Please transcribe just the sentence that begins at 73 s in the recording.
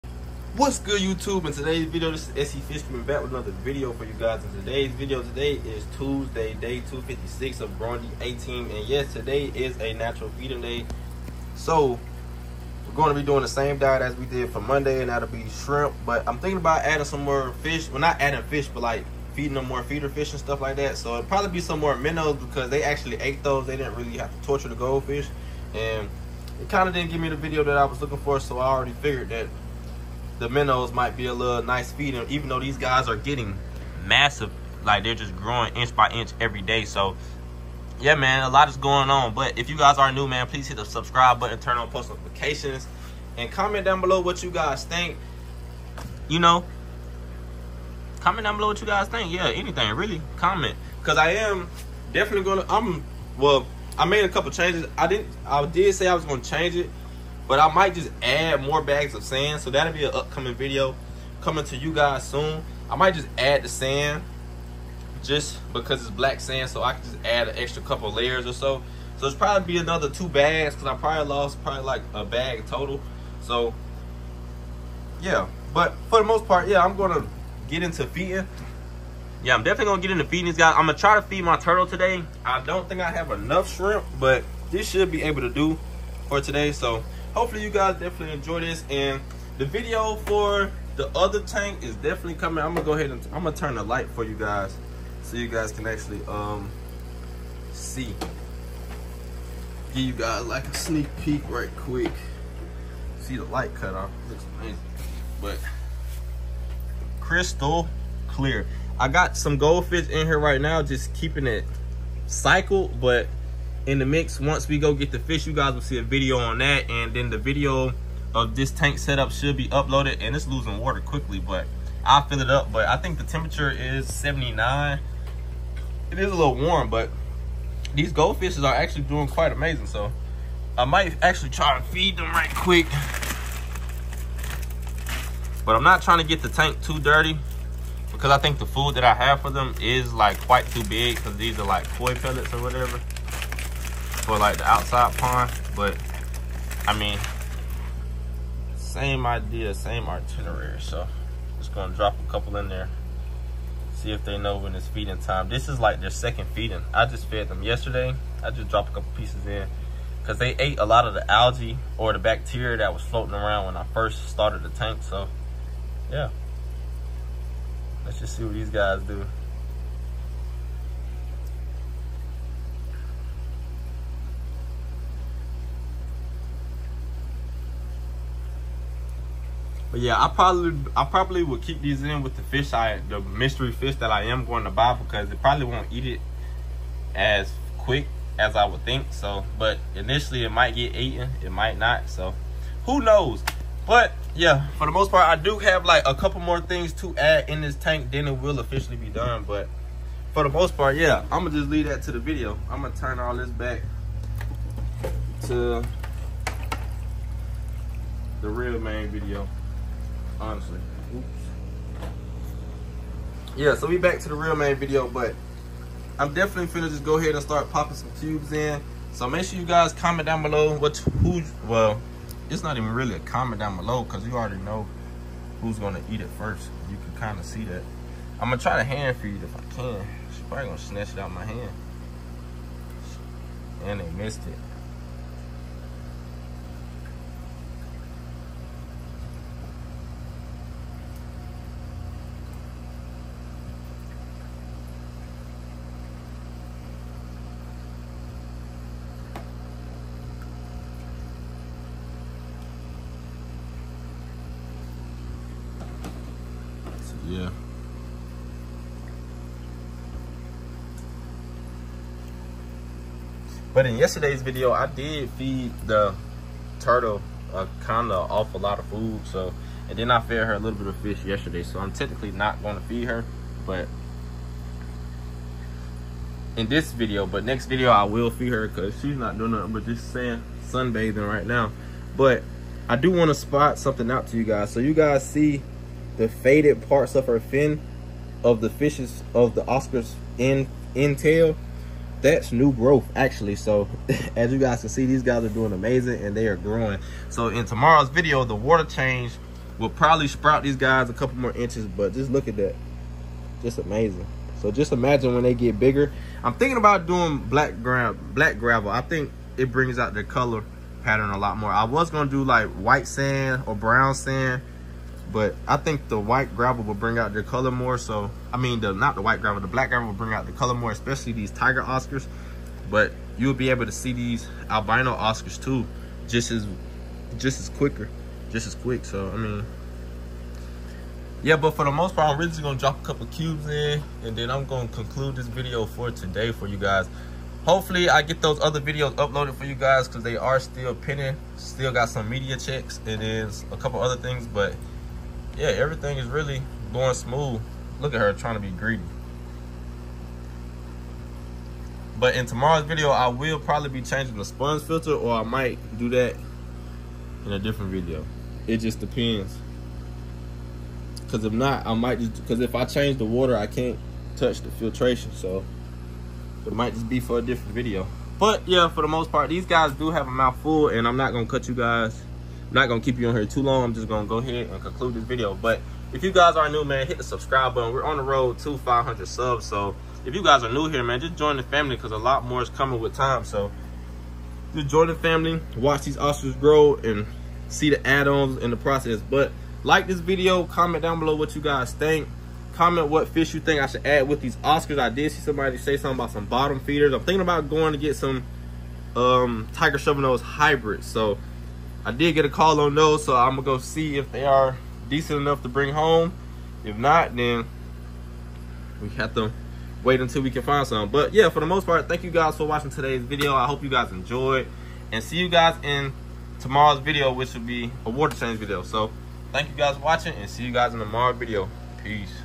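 So yeah, but for the most part, yeah, I'm gonna get into feeding.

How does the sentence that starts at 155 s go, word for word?
This is like their second feeding.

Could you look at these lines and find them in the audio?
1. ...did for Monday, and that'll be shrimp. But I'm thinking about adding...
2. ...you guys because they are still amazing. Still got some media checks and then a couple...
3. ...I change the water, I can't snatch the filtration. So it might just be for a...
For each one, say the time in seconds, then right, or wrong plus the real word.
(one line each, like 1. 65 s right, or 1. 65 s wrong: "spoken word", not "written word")
1. 14 s right
2. 339 s wrong: "pending", not "amazing"
3. 362 s wrong: "touch", not "snatch".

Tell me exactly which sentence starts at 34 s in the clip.
Like they're just growing inch by inch every day.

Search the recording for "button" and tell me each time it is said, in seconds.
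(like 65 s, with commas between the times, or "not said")
41 s, 377 s.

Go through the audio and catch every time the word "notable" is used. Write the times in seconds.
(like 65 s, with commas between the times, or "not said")
not said.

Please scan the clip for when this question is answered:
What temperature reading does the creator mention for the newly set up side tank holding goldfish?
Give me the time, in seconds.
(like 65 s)
124 s.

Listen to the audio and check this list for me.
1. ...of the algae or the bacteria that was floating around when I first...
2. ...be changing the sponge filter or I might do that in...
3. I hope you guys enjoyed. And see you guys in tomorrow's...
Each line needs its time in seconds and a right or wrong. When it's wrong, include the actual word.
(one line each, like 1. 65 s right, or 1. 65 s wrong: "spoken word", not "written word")
1. 161 s right
2. 353 s right
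3. 413 s right.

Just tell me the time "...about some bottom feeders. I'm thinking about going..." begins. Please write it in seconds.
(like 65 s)
396 s.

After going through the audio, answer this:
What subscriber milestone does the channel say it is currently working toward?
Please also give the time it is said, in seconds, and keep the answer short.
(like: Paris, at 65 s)
500, at 378 s.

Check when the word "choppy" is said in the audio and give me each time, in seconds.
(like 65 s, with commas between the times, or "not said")
not said.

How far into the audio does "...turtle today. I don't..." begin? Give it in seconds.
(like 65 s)
81 s.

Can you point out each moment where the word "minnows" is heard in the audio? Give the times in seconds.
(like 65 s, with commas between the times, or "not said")
21 s, 30 s.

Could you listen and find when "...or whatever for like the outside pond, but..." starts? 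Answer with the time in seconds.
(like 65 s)
142 s.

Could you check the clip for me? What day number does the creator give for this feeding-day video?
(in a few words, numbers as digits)
256.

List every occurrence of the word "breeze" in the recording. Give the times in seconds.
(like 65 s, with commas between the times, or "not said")
not said.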